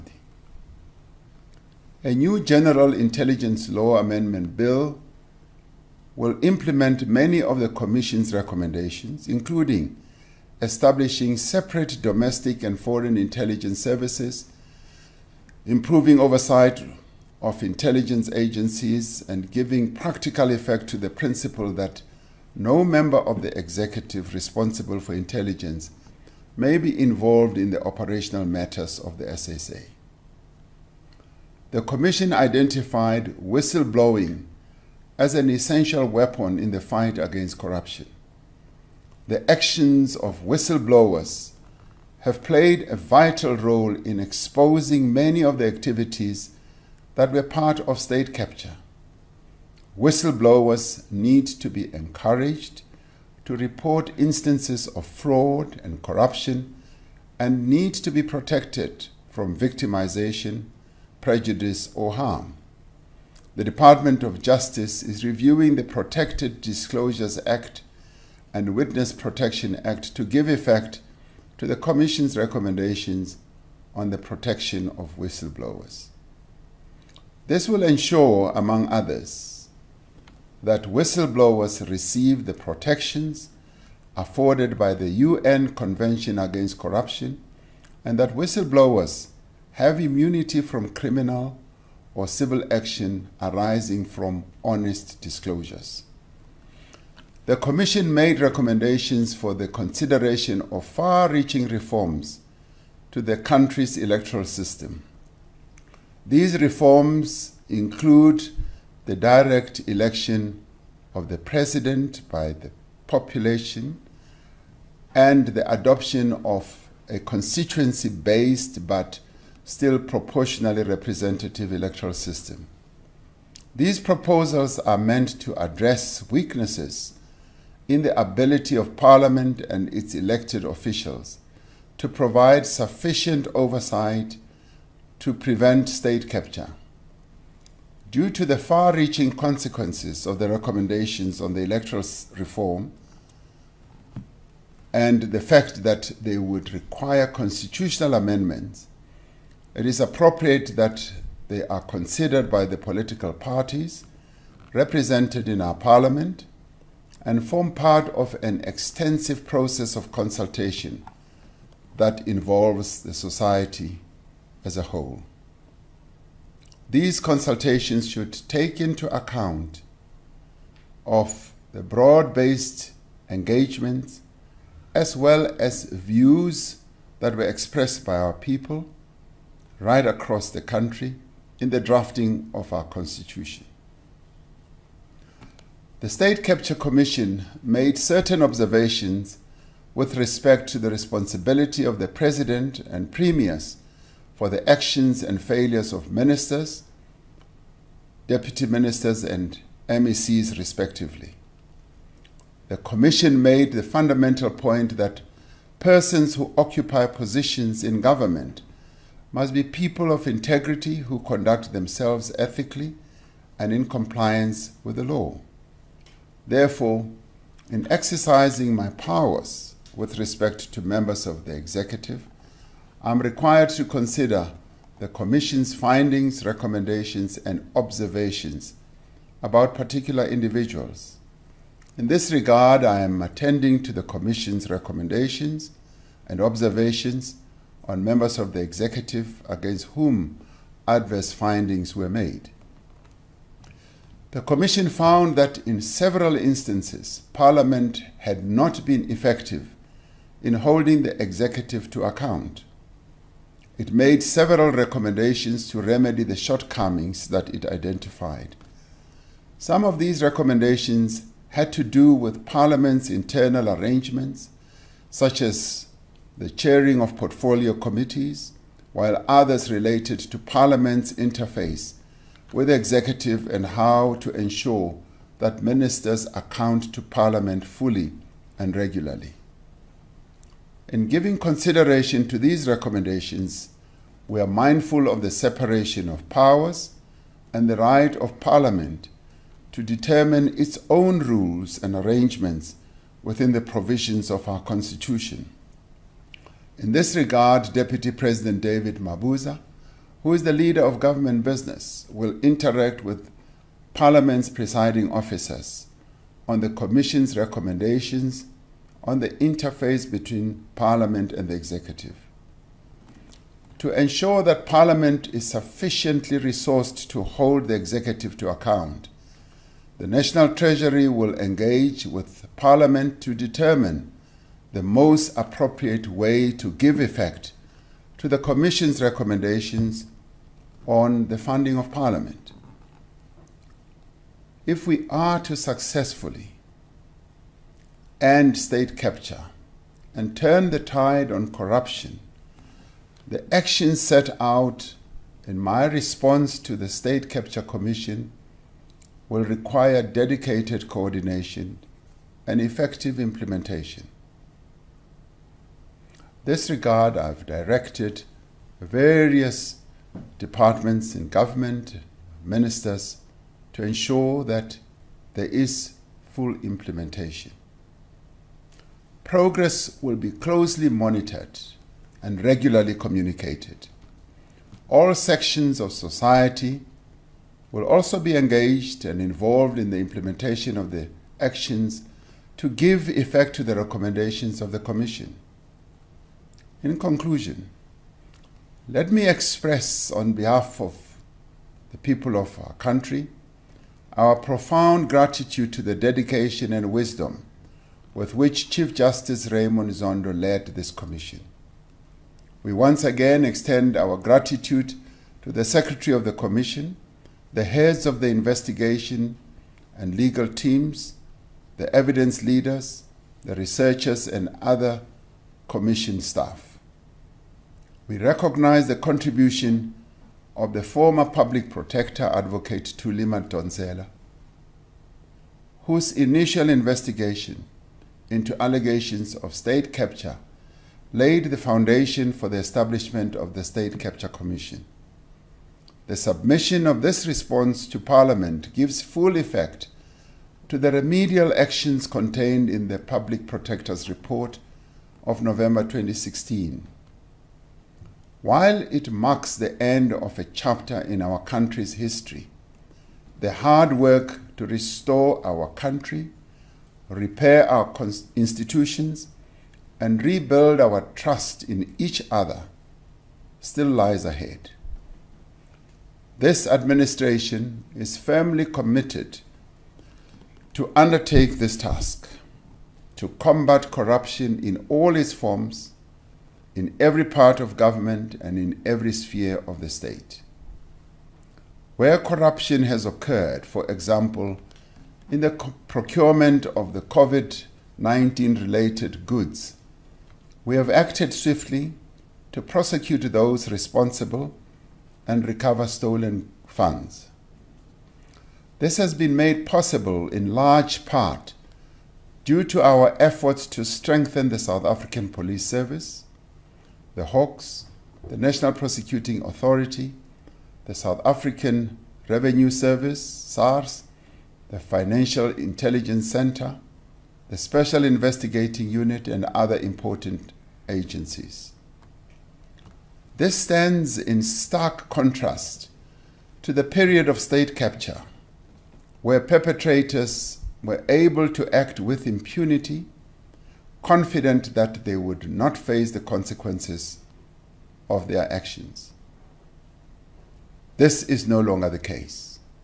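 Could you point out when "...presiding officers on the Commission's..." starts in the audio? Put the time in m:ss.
5:04.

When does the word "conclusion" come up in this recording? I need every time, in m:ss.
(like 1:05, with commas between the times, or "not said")
6:26.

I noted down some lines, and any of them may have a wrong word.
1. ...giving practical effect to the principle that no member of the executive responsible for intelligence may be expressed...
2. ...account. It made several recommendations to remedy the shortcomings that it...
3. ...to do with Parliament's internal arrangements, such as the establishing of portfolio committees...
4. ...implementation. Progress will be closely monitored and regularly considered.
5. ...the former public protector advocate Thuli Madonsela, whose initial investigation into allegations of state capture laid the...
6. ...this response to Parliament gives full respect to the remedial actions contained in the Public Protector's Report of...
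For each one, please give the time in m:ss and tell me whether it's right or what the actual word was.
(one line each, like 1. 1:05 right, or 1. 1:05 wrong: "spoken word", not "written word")
1. 0:19 wrong: "involved", not "expressed"
2. 4:12 right
3. 4:21 wrong: "chairing", not "establishing"
4. 6:06 wrong: "communicated", not "considered"
5. 7:00 right
6. 7:17 wrong: "effect", not "respect".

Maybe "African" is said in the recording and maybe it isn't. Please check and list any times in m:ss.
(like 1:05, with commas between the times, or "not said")
8:24, 8:31.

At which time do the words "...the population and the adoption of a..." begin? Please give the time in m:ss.
1:52.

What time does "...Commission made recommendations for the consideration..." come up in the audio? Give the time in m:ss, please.
1:37.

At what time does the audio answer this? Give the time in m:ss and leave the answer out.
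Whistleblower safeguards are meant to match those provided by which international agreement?
1:25.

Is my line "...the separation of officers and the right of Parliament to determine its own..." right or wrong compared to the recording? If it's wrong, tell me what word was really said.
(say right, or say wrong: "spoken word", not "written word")
wrong: "powers", not "officers".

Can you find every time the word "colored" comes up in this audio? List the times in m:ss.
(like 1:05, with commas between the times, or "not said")
not said.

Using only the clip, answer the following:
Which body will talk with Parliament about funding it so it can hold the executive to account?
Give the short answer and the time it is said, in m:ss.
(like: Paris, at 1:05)
National Treasury, at 5:20.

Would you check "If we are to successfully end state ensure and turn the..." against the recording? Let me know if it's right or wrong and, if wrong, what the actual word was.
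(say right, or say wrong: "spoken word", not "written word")
wrong: "capture", not "ensure".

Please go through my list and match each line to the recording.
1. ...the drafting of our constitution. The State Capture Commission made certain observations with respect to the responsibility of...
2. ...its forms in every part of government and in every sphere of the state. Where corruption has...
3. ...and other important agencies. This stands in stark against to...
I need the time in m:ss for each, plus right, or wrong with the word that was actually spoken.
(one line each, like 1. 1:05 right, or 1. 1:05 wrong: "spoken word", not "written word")
1. 3:01 right
2. 7:55 right
3. 8:39 wrong: "contrast", not "against".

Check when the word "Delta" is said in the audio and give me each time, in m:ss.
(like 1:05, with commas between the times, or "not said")
not said.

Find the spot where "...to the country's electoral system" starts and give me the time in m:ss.
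1:43.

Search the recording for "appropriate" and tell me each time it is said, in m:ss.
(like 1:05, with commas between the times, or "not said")
2:29, 5:25.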